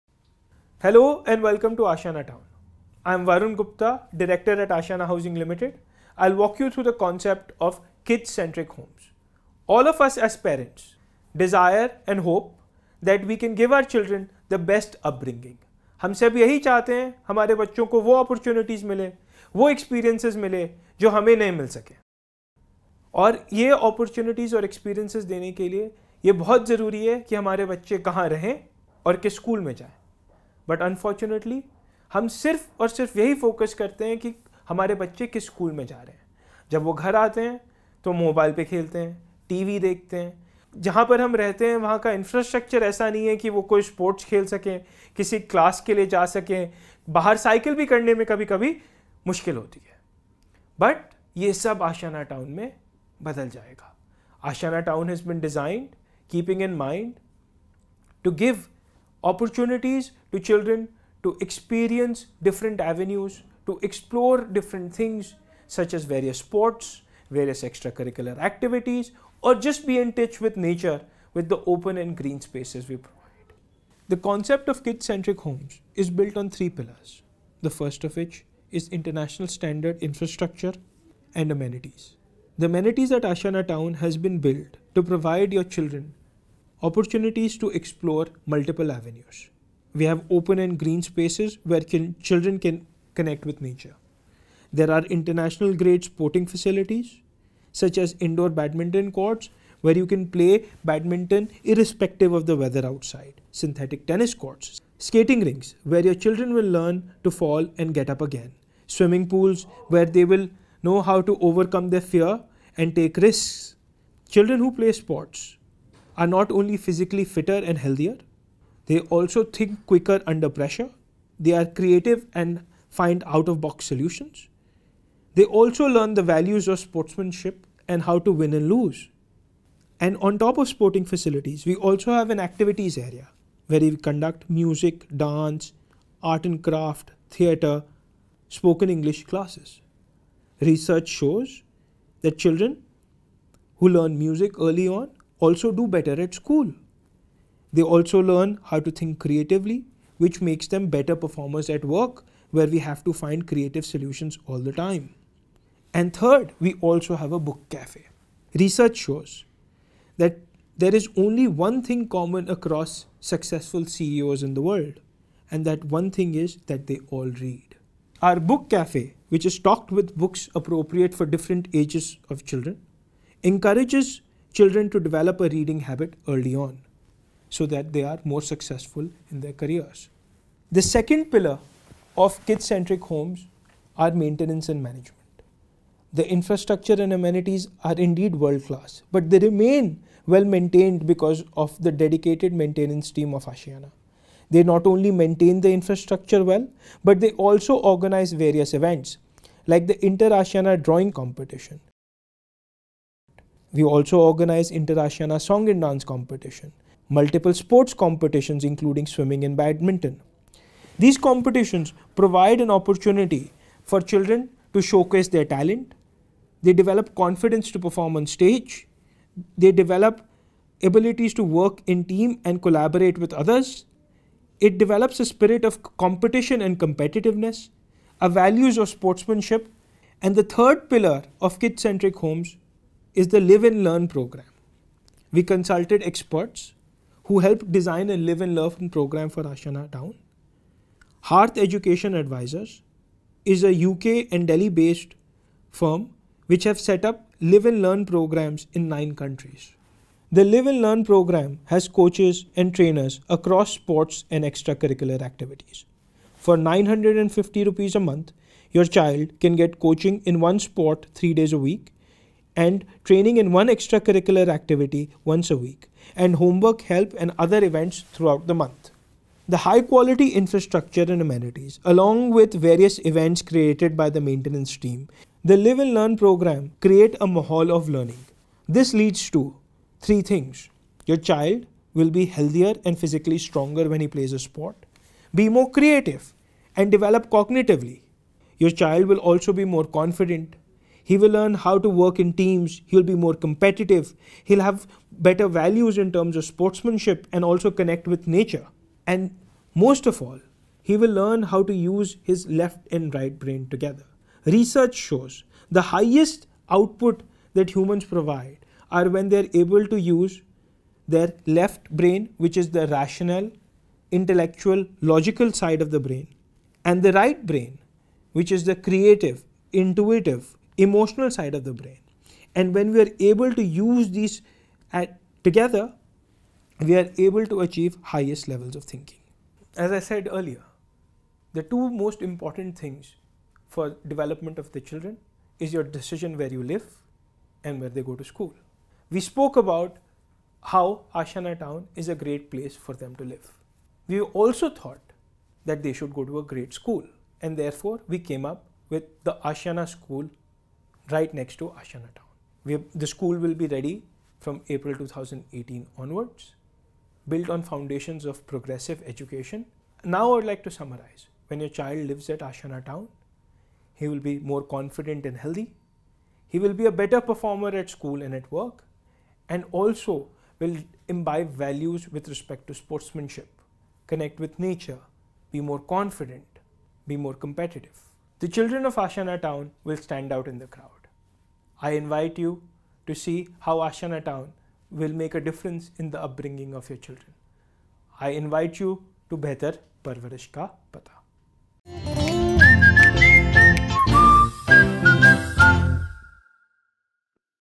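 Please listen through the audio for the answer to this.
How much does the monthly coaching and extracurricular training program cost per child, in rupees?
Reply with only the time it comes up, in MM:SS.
04:16.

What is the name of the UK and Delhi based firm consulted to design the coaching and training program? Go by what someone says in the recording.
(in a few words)
Hearth Education Advisors.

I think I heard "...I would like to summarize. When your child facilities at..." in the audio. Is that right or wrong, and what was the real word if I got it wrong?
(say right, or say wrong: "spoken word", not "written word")
wrong: "lives", not "facilities".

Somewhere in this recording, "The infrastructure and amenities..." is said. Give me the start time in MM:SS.
03:06.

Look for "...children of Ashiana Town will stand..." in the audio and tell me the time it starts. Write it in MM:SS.
06:18.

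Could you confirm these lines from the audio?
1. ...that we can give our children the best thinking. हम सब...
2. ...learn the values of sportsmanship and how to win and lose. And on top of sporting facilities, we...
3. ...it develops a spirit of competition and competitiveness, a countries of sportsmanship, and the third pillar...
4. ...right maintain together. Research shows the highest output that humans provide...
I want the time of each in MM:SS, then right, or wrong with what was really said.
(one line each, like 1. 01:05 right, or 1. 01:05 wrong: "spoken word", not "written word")
1. 00:13 wrong: "upbringing", not "thinking"
2. 02:05 right
3. 03:44 wrong: "values", not "countries"
4. 05:03 wrong: "brain", not "maintain".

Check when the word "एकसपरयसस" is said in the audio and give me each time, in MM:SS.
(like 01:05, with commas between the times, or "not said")
00:19, 00:24.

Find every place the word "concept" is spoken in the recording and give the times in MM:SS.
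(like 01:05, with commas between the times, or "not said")
00:07, 01:14.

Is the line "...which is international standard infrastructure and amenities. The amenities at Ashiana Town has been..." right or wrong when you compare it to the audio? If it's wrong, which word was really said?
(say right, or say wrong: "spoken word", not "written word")
right.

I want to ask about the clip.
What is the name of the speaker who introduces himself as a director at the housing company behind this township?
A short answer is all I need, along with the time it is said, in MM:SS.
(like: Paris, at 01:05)
Varun Gupta, at 00:03.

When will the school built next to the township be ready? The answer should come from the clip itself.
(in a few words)
April 2018.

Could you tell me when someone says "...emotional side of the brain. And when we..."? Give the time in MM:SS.
05:20.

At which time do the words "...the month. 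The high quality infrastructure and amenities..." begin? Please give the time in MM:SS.
04:28.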